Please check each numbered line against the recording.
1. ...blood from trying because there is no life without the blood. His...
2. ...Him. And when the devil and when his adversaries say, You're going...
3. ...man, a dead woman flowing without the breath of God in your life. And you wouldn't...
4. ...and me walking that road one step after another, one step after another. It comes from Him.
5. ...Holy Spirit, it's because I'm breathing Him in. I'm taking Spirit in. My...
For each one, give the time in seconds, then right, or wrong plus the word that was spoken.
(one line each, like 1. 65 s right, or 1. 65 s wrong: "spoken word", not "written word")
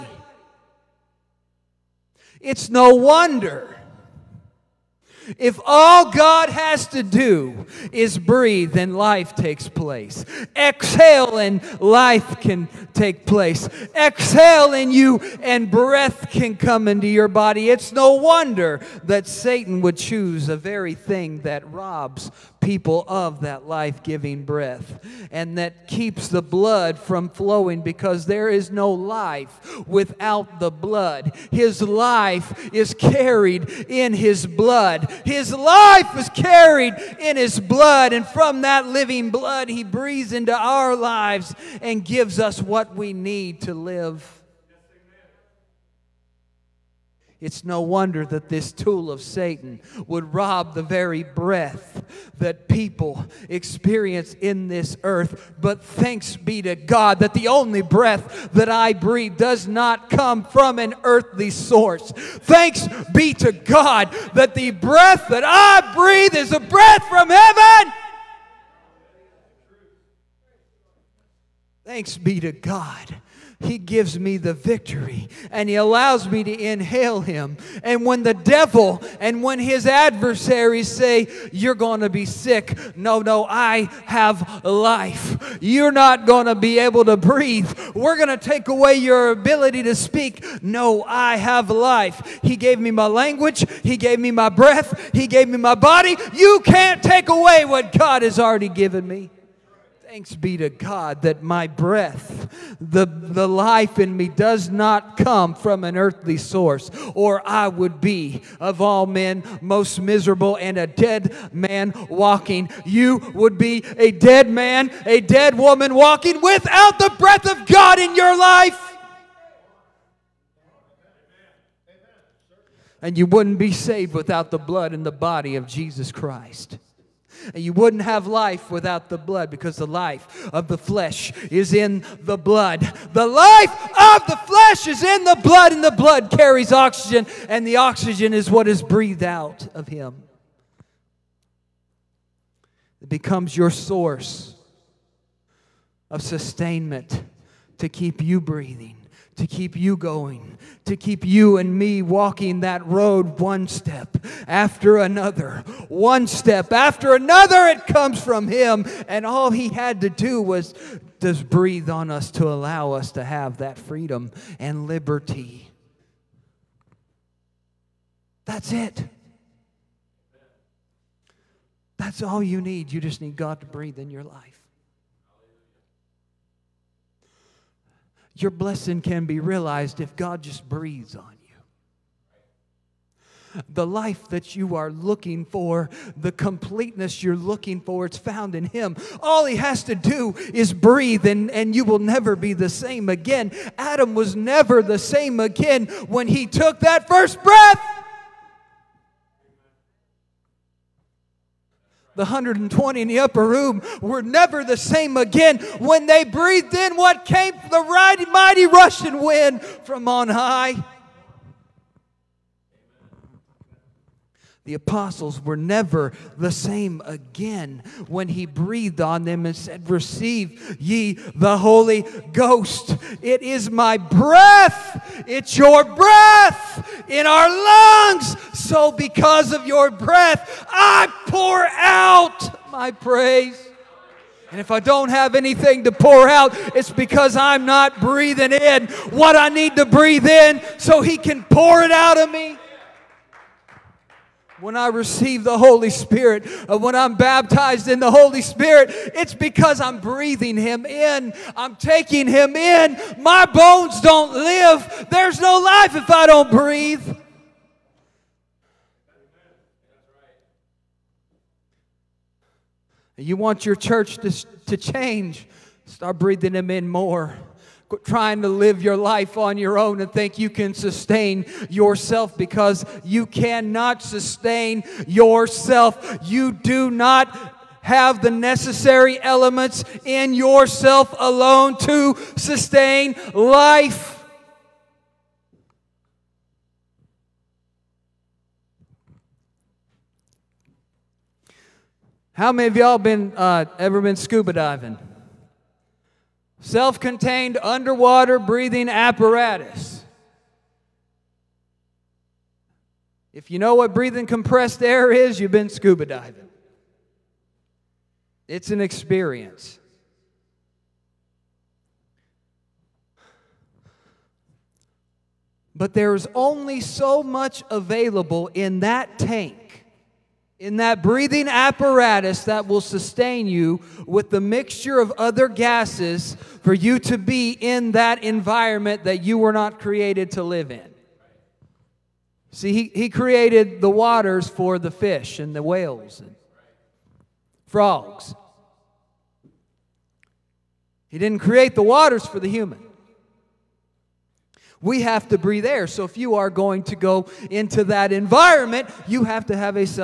1. 26 s wrong: "flowing", not "trying"
2. 77 s right
3. 114 s wrong: "walking", not "flowing"
4. 151 s right
5. 248 s wrong: "Him", not "Spirit".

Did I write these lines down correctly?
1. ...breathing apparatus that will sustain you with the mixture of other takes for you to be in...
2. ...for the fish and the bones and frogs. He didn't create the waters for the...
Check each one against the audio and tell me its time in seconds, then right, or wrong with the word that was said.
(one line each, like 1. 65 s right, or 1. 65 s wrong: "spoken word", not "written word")
1. 321 s wrong: "gases", not "takes"
2. 334 s wrong: "whales", not "bones".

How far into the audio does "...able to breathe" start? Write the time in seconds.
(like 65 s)
86 s.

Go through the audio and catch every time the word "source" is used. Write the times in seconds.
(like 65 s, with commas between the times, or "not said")
61 s, 106 s, 143 s.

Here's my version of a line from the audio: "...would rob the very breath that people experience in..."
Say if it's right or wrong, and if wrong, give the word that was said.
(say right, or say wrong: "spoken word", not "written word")
right.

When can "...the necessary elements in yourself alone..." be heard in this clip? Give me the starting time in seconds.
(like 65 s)
278 s.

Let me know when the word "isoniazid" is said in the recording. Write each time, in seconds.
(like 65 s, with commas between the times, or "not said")
not said.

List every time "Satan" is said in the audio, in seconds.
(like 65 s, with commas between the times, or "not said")
19 s, 49 s.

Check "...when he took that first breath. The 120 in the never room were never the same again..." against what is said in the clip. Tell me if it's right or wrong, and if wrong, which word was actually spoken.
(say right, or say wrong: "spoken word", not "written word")
wrong: "upper", not "never".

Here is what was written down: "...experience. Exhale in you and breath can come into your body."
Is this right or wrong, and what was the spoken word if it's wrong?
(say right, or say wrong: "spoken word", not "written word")
wrong: "place", not "experience".